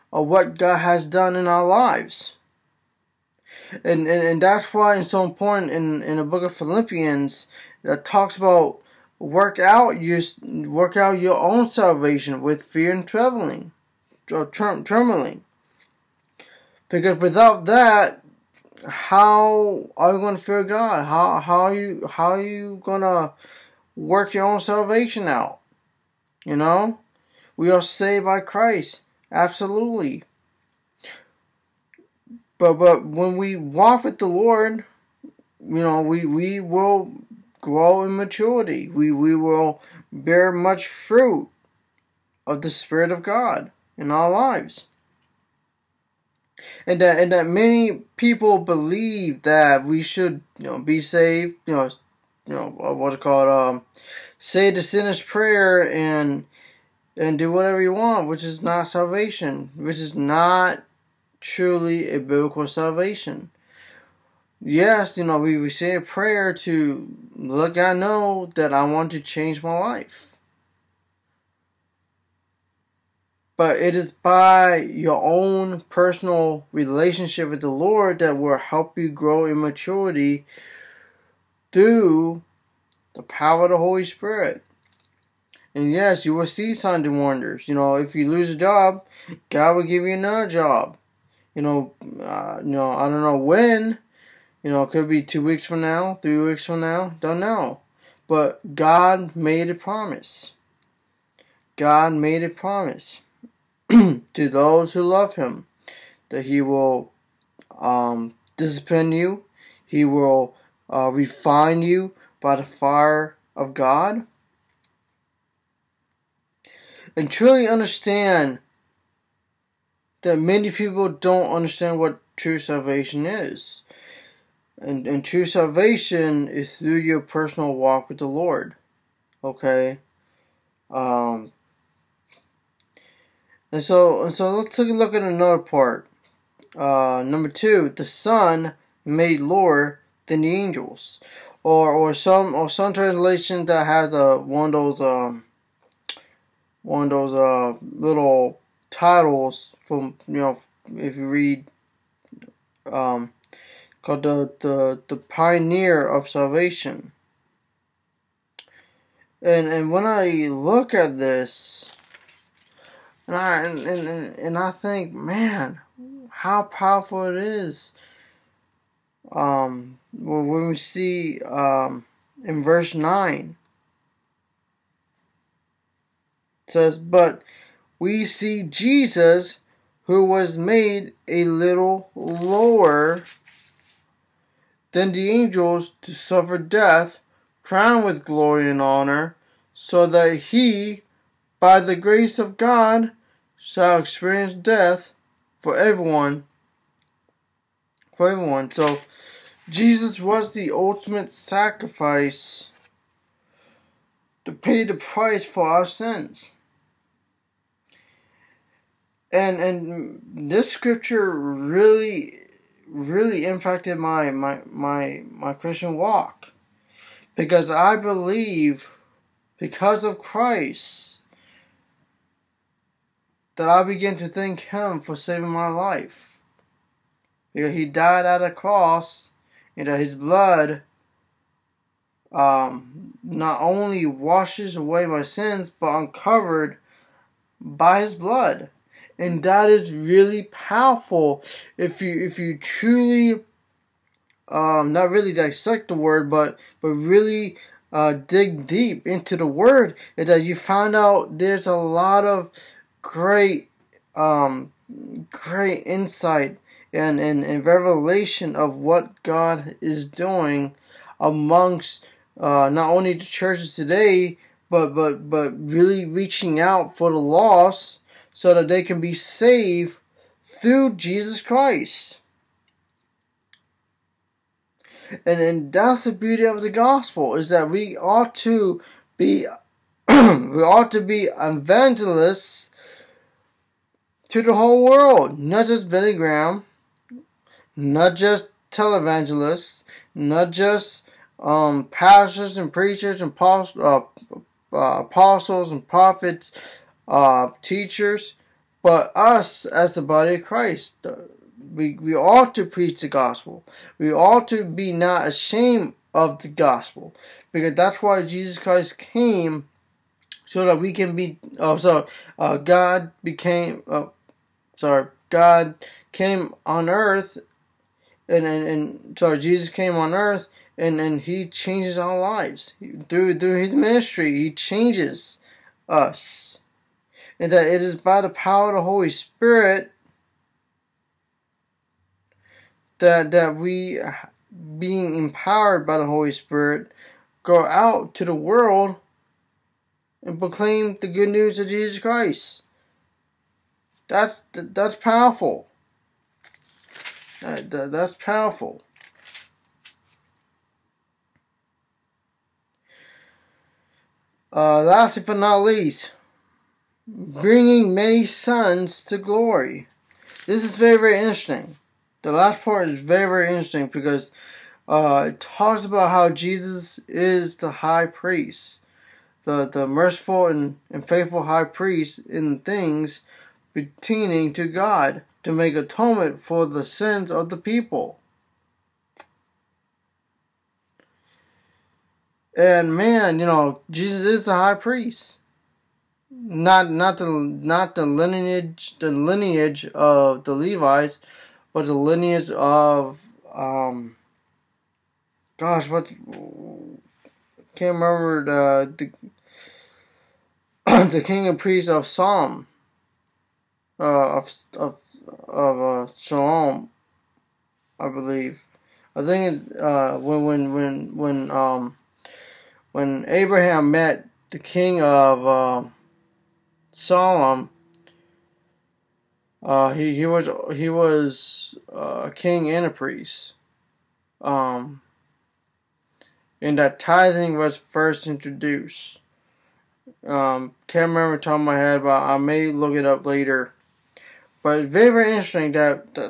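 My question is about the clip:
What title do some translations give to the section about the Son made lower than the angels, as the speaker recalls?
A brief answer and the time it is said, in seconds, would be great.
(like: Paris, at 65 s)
The pioneer of salvation, at 155 s.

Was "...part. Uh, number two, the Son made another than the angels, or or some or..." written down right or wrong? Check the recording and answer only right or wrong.
wrong.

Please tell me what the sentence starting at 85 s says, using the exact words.
And yes, you will see signs and wonders.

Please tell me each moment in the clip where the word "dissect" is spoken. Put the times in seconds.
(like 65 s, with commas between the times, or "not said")
245 s.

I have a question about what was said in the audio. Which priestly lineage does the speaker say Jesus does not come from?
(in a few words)
The Levites.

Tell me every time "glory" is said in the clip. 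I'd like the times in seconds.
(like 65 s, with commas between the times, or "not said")
188 s, 359 s.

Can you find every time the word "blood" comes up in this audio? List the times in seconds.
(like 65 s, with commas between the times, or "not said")
230 s, 238 s.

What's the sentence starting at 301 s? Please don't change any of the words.
Uh, we, we ought to preach the gospel.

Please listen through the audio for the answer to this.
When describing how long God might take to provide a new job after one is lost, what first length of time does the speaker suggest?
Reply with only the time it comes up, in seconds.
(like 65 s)
95 s.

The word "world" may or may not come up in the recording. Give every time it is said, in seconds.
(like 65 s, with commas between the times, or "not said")
284 s, 338 s.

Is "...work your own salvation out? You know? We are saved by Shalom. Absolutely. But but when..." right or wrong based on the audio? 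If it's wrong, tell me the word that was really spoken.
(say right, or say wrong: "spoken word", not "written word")
wrong: "Christ", not "Shalom".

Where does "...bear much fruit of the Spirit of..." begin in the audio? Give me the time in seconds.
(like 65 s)
40 s.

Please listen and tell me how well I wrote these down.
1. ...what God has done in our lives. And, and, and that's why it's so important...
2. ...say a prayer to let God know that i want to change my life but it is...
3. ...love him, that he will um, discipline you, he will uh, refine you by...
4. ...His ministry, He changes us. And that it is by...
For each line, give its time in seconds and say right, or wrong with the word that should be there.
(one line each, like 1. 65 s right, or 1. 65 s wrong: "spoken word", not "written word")
1. 0 s right
2. 65 s right
3. 105 s right
4. 323 s right.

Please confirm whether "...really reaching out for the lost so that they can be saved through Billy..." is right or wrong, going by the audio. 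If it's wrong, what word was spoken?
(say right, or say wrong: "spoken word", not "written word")
wrong: "Jesus", not "Billy".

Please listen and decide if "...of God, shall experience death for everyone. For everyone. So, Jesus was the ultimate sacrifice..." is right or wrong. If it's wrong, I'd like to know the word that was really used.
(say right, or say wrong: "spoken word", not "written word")
right.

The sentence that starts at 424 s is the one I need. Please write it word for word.
Um, and that tithing was first introduced.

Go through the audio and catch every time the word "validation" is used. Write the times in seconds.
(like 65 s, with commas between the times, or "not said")
not said.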